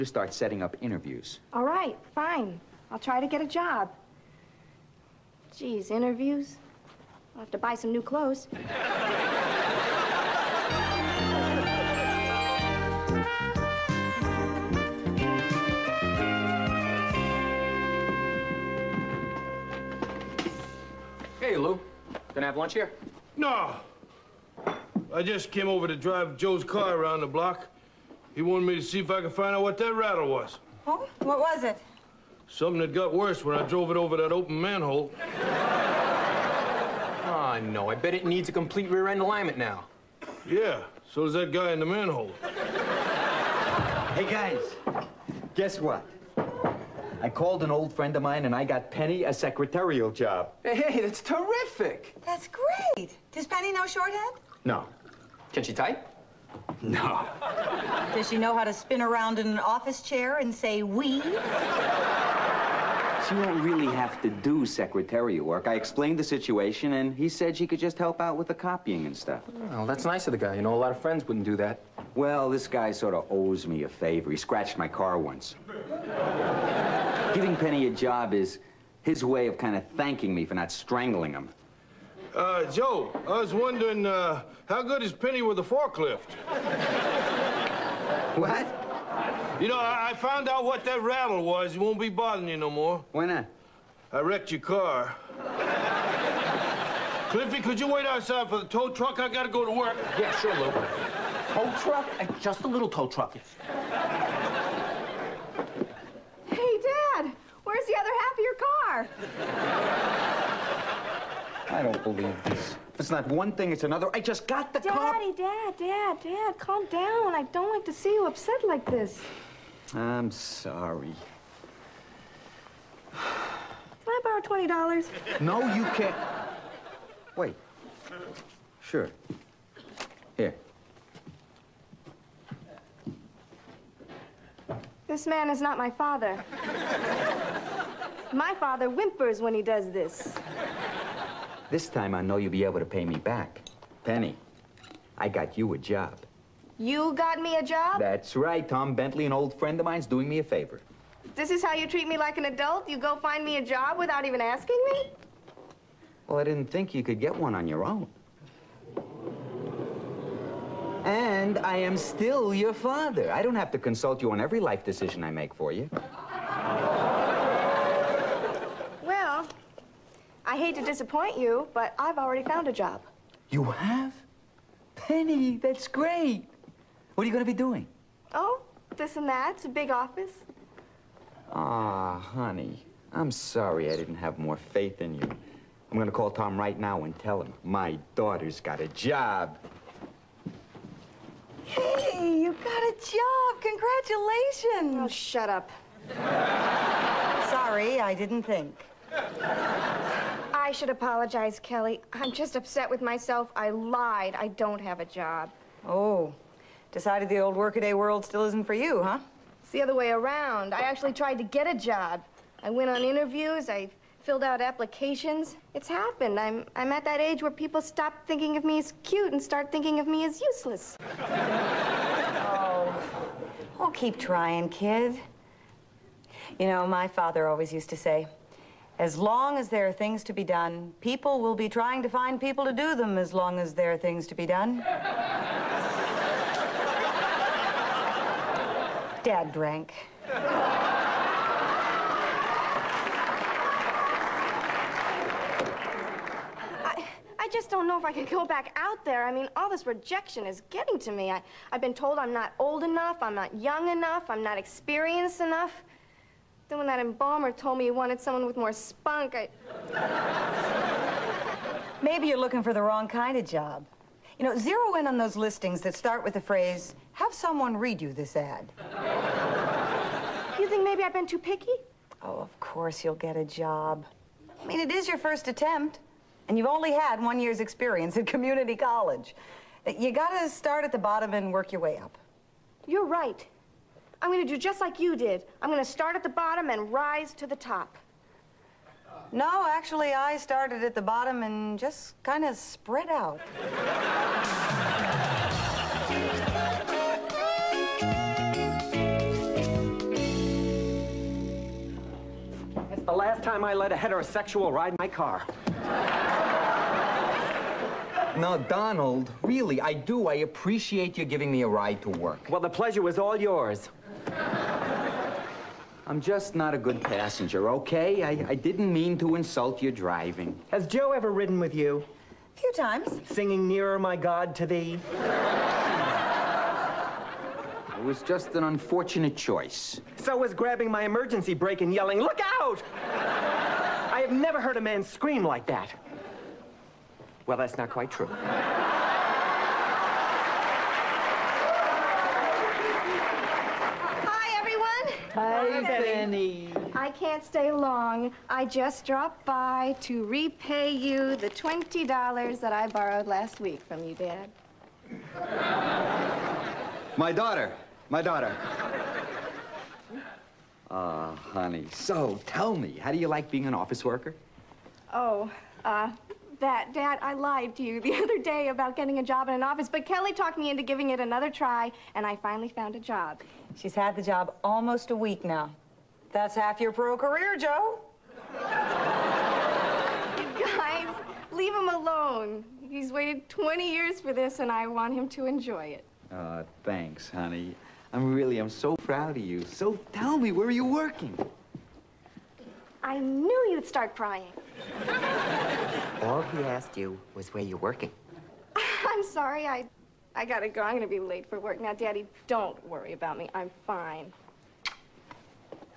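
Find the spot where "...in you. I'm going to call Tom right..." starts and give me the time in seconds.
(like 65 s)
185 s.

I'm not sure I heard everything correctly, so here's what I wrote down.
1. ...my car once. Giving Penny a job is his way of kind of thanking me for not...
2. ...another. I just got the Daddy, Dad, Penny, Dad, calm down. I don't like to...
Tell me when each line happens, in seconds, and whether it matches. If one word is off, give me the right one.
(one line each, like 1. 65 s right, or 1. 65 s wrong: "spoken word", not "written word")
1. 74 s right
2. 113 s wrong: "Dad", not "Penny".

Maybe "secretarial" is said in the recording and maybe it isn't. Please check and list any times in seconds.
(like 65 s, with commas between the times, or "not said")
49 s, 64 s.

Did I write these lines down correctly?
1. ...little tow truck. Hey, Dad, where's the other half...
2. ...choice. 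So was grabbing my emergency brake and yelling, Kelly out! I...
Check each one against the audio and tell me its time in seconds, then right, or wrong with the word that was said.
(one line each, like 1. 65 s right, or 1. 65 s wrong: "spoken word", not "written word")
1. 102 s right
2. 329 s wrong: "Look", not "Kelly".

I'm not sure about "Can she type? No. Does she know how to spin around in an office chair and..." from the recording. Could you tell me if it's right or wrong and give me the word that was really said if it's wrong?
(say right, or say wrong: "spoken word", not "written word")
right.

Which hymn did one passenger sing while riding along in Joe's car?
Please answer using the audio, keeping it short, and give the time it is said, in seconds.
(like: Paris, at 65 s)
Nearer My God to Thee, at 323 s.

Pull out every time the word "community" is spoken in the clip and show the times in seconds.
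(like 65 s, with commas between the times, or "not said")
278 s.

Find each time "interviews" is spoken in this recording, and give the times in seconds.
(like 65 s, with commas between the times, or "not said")
0 s, 5 s, 213 s.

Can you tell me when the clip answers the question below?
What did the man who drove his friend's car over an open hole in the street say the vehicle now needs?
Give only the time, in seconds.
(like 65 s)
38 s.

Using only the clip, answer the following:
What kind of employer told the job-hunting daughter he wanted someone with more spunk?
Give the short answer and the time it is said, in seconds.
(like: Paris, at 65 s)
embalmer, at 257 s.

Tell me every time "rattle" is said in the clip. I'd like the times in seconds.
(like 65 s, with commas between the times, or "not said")
29 s, 91 s.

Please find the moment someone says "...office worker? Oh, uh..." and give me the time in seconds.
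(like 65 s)
363 s.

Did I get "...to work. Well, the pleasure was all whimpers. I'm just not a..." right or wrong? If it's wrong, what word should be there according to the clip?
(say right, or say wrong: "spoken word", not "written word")
wrong: "yours", not "whimpers".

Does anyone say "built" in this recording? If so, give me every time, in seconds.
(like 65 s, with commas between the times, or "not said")
not said.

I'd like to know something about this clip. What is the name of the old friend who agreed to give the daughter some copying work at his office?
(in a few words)
Tom Bentley.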